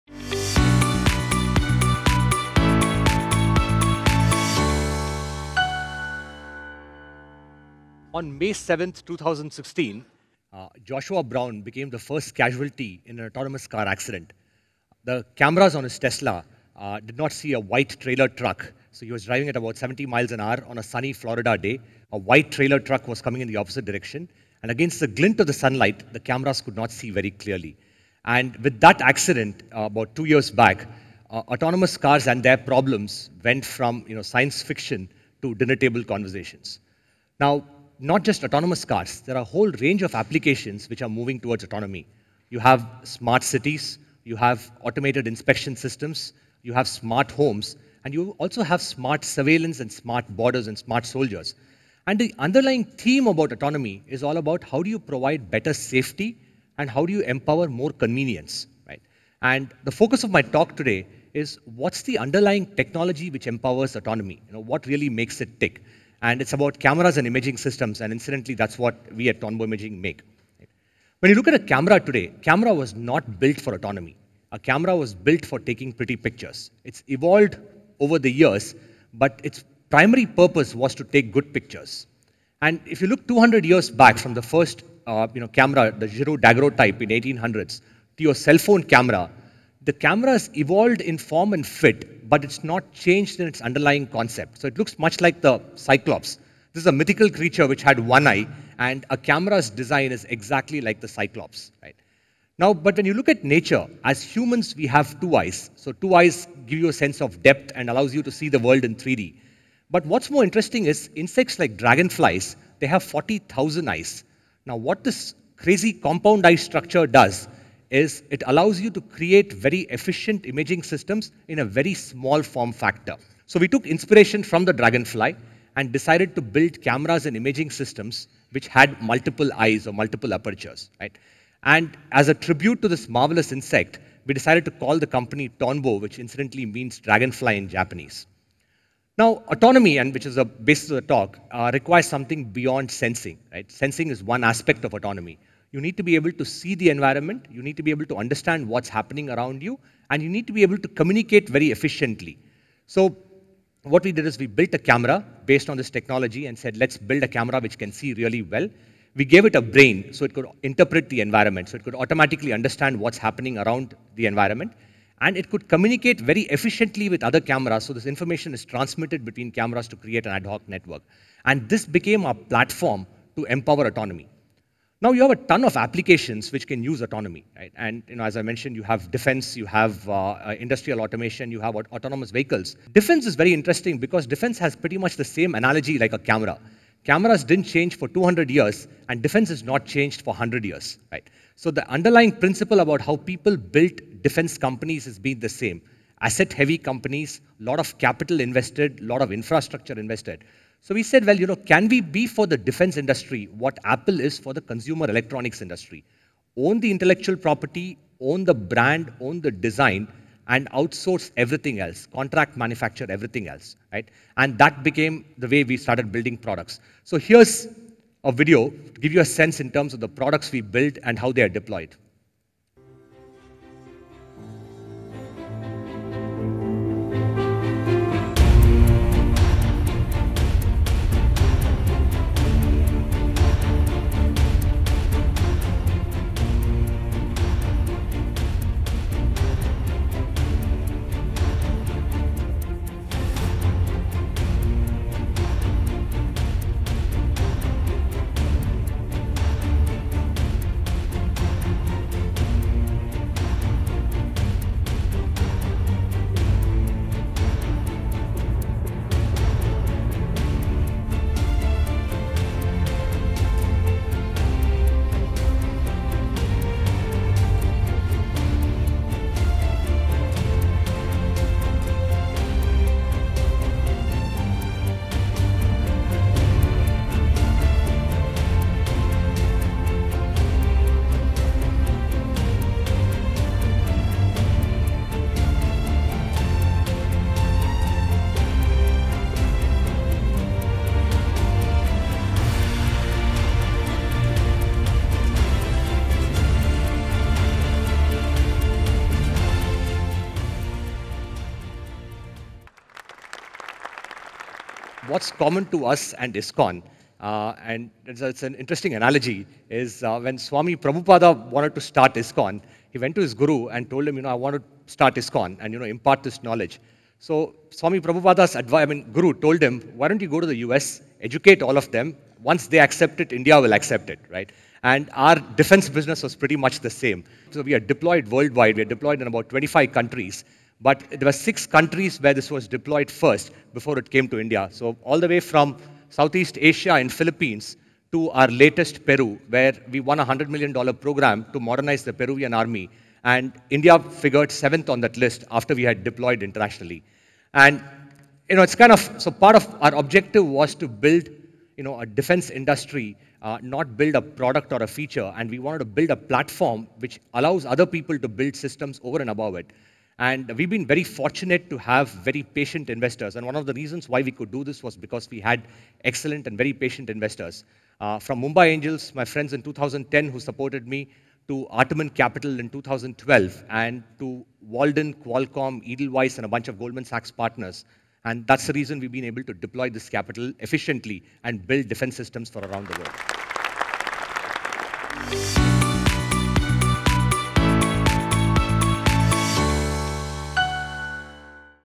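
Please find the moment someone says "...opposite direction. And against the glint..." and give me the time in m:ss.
0:23.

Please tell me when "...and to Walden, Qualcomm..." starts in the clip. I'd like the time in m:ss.
6:13.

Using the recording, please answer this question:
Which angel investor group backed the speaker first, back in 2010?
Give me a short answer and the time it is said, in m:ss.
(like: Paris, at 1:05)
Mumbai Angels, at 6:08.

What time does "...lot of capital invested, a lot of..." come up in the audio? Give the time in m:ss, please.
3:17.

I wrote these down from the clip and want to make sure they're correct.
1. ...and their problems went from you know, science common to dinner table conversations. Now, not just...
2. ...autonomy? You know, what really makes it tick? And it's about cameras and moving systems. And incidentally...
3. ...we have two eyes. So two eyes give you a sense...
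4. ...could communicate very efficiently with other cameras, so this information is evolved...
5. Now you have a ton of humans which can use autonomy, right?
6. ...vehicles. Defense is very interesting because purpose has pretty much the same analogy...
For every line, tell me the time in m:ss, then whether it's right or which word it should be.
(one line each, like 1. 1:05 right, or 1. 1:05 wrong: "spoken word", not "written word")
1. 0:32 wrong: "fiction", not "common"
2. 1:03 wrong: "imaging", not "moving"
3. 1:44 right
4. 2:45 wrong: "transmitted", not "evolved"
5. 2:55 wrong: "applications", not "humans"
6. 3:02 wrong: "defense", not "purpose".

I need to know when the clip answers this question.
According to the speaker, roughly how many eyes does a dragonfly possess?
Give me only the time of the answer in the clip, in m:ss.
1:53.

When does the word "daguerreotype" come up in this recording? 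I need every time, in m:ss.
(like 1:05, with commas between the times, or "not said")
1:26.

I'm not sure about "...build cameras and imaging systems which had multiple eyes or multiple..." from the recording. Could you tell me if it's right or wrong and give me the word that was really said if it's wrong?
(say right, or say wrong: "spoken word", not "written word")
right.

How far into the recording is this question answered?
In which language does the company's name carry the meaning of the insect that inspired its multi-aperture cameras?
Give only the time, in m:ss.
2:17.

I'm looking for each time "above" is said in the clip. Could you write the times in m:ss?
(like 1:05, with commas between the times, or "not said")
5:59.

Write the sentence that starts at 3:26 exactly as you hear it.
Own the intellectual property, own the brand, own the design, and outsource everything else, contract manufacture everything else, right?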